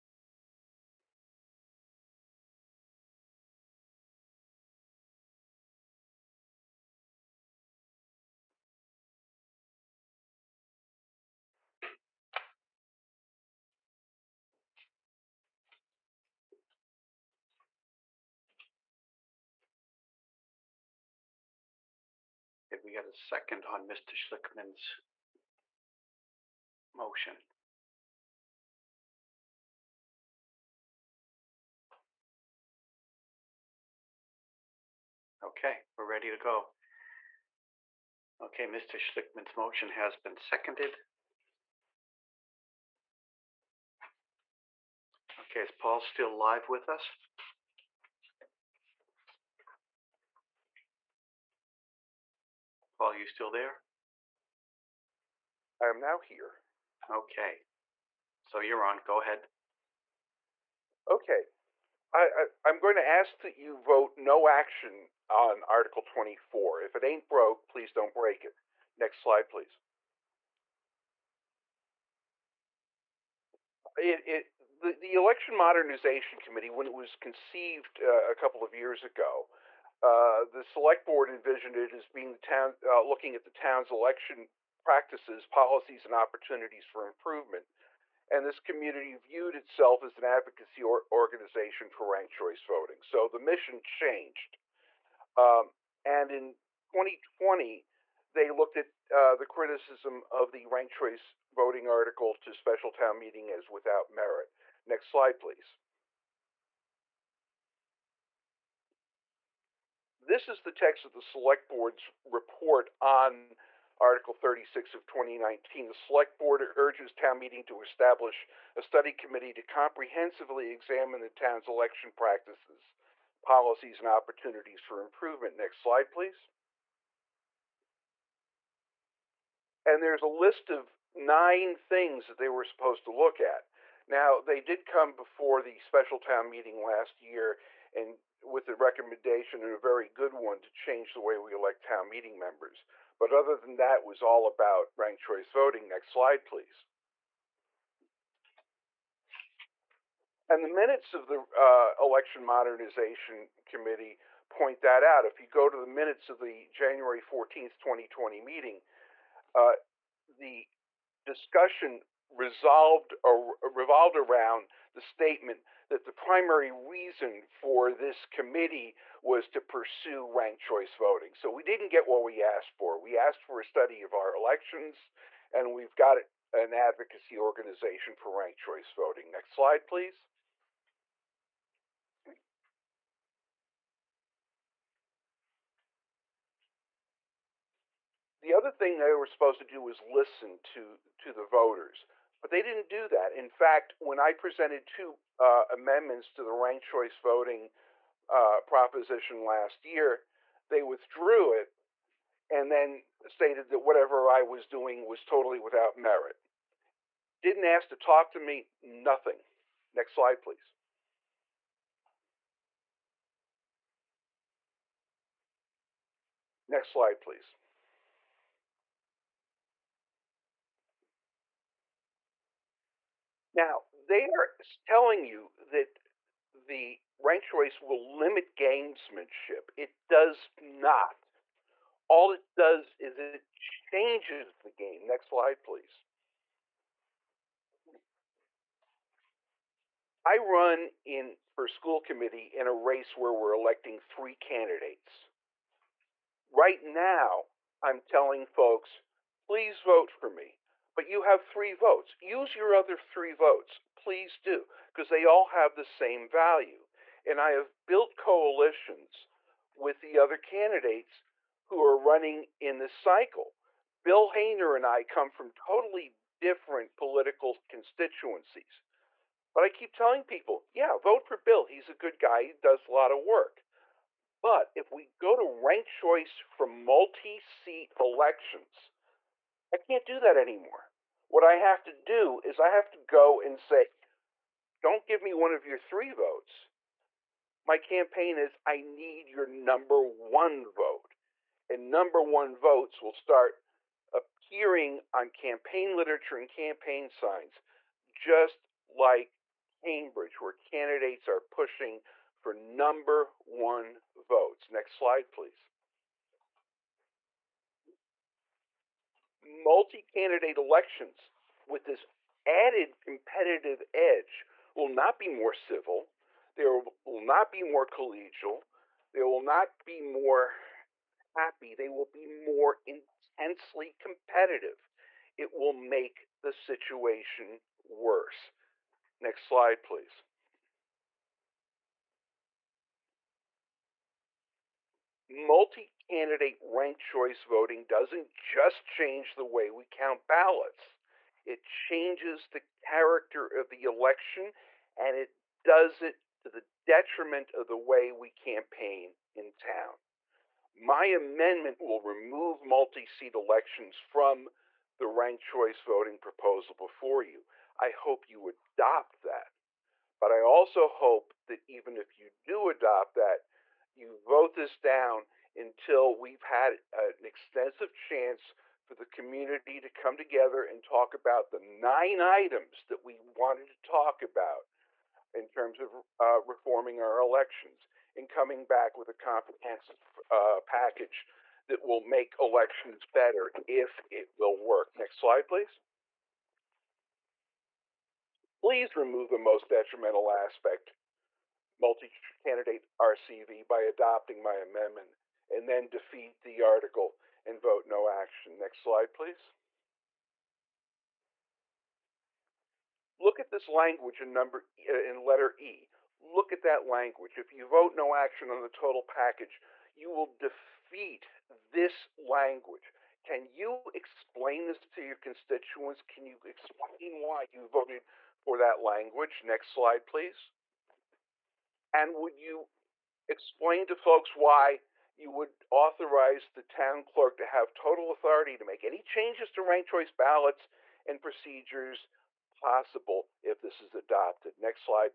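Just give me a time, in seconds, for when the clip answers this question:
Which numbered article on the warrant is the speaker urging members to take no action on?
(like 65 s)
65 s.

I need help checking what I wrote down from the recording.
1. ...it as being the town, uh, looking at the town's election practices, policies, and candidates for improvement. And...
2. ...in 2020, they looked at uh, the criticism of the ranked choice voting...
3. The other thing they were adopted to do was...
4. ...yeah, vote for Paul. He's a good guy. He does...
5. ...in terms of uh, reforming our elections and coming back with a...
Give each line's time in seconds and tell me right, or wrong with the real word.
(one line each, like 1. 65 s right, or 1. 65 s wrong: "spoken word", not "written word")
1. 81 s wrong: "opportunities", not "candidates"
2. 96 s right
3. 188 s wrong: "supposed", not "adopted"
4. 270 s wrong: "Bill", not "Paul"
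5. 375 s right.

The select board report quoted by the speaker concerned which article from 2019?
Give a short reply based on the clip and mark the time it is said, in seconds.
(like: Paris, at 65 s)
Article 36, at 113 s.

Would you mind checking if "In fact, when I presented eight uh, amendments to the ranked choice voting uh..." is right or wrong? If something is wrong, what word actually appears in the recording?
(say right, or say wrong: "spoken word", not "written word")
wrong: "two", not "eight".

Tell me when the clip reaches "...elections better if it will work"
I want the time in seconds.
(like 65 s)
382 s.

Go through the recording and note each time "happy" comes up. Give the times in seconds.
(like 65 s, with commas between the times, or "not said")
321 s.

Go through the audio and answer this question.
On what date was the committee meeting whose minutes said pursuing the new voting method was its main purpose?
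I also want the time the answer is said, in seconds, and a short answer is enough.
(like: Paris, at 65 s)
January 14, 2020, at 156 s.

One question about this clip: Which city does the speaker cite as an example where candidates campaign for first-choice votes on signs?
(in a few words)
Cambridge.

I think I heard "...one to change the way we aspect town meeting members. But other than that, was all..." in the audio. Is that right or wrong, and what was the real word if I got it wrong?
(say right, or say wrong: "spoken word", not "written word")
wrong: "elect", not "aspect".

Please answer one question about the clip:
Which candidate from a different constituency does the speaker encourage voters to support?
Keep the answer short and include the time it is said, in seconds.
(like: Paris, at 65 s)
Bill Hayner, at 264 s.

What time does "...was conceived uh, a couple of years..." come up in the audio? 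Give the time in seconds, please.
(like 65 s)
76 s.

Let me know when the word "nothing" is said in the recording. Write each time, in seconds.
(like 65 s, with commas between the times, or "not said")
208 s.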